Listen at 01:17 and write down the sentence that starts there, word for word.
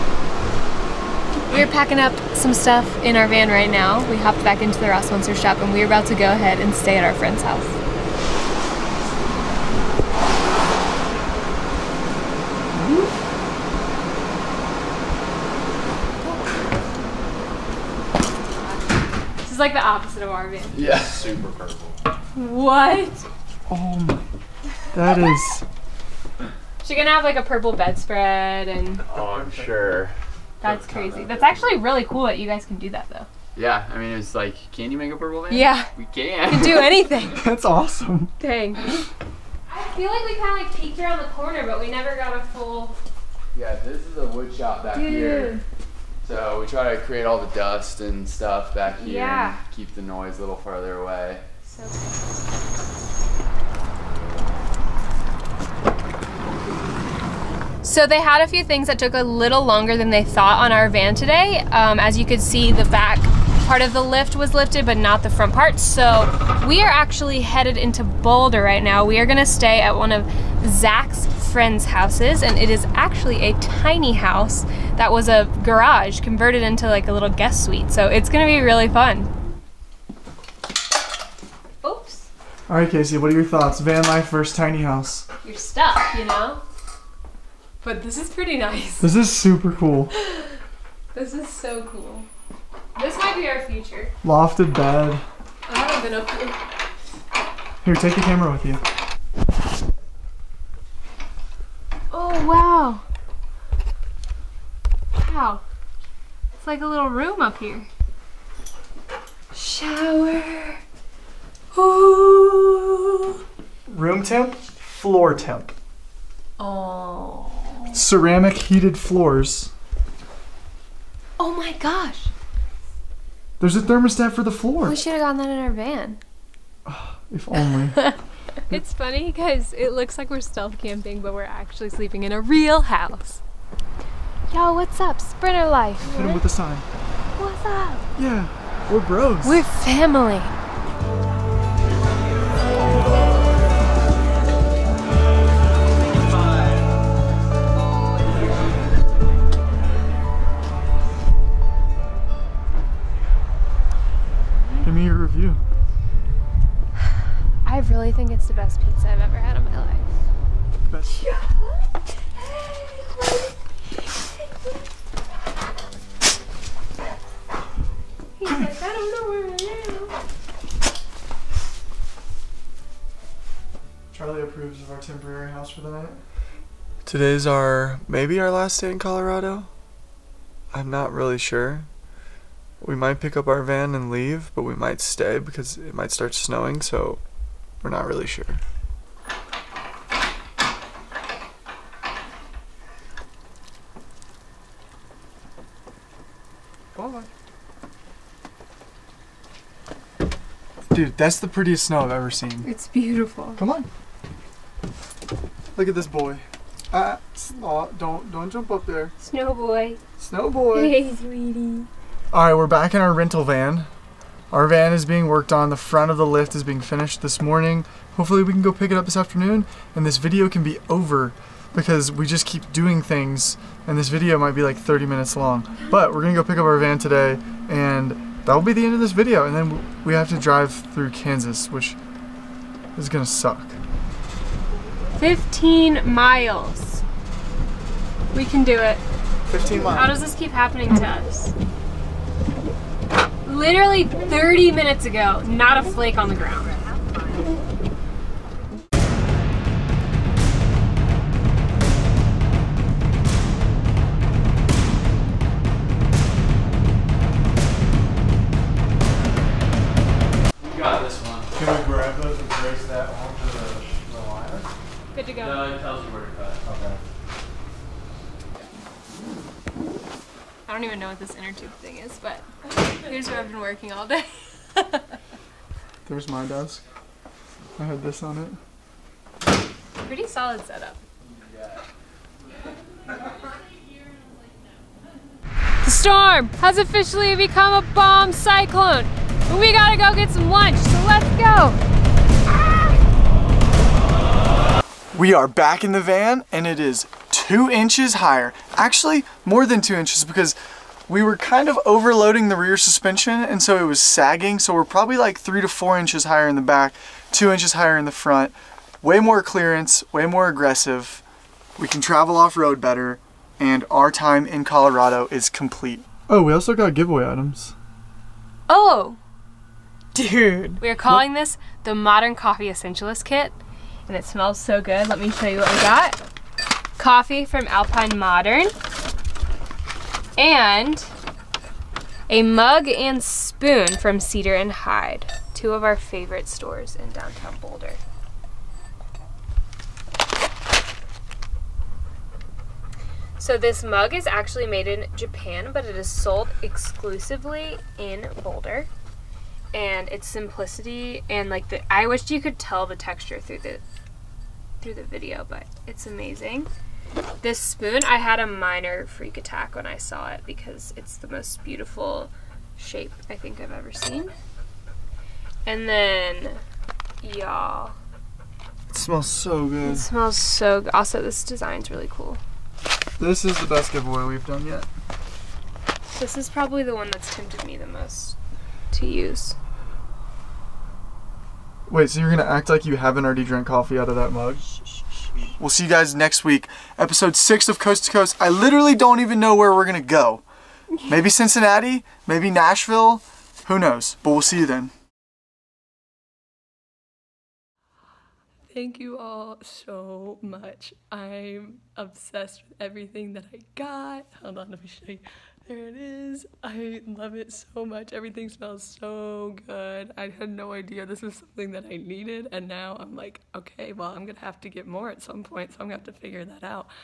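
So it's gonna be really fun.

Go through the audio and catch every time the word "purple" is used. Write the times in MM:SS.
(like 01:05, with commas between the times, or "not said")
00:21, 00:27, 00:35.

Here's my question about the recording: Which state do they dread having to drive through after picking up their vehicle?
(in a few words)
Kansas.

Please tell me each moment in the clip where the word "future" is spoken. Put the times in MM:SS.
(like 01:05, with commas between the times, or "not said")
01:33.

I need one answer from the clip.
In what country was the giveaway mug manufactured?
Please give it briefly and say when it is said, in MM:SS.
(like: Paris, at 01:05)
Japan, at 05:45.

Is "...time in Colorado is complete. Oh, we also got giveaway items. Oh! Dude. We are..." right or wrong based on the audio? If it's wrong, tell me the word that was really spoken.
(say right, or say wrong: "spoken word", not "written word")
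right.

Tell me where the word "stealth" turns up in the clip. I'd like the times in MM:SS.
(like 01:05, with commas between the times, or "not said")
02:10.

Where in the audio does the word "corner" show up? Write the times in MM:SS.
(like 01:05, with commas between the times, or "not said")
00:41.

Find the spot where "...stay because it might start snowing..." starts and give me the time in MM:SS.
03:05.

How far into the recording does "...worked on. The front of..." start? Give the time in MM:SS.
03:35.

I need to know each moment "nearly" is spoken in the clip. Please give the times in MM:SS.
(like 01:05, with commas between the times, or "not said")
not said.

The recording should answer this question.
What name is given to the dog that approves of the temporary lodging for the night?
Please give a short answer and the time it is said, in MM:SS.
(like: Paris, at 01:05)
Charlie, at 02:54.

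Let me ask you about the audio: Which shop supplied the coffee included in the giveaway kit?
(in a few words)
Alpine Modern.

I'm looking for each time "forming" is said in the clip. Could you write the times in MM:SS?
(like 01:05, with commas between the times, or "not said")
not said.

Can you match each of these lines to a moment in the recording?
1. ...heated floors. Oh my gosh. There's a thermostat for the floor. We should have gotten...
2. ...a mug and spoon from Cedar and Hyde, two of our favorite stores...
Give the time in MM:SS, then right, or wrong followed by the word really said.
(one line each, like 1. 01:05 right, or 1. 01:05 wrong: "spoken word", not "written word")
1. 01:58 right
2. 05:32 right.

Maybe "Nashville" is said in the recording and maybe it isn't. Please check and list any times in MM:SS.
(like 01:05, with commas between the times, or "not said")
06:32.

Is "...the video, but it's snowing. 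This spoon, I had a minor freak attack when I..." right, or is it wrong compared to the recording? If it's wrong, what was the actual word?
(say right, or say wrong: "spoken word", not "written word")
wrong: "amazing", not "snowing".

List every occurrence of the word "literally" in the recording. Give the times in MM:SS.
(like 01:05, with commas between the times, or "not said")
04:03, 06:28.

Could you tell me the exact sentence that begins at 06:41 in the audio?
I'm obsessed with everything that I got.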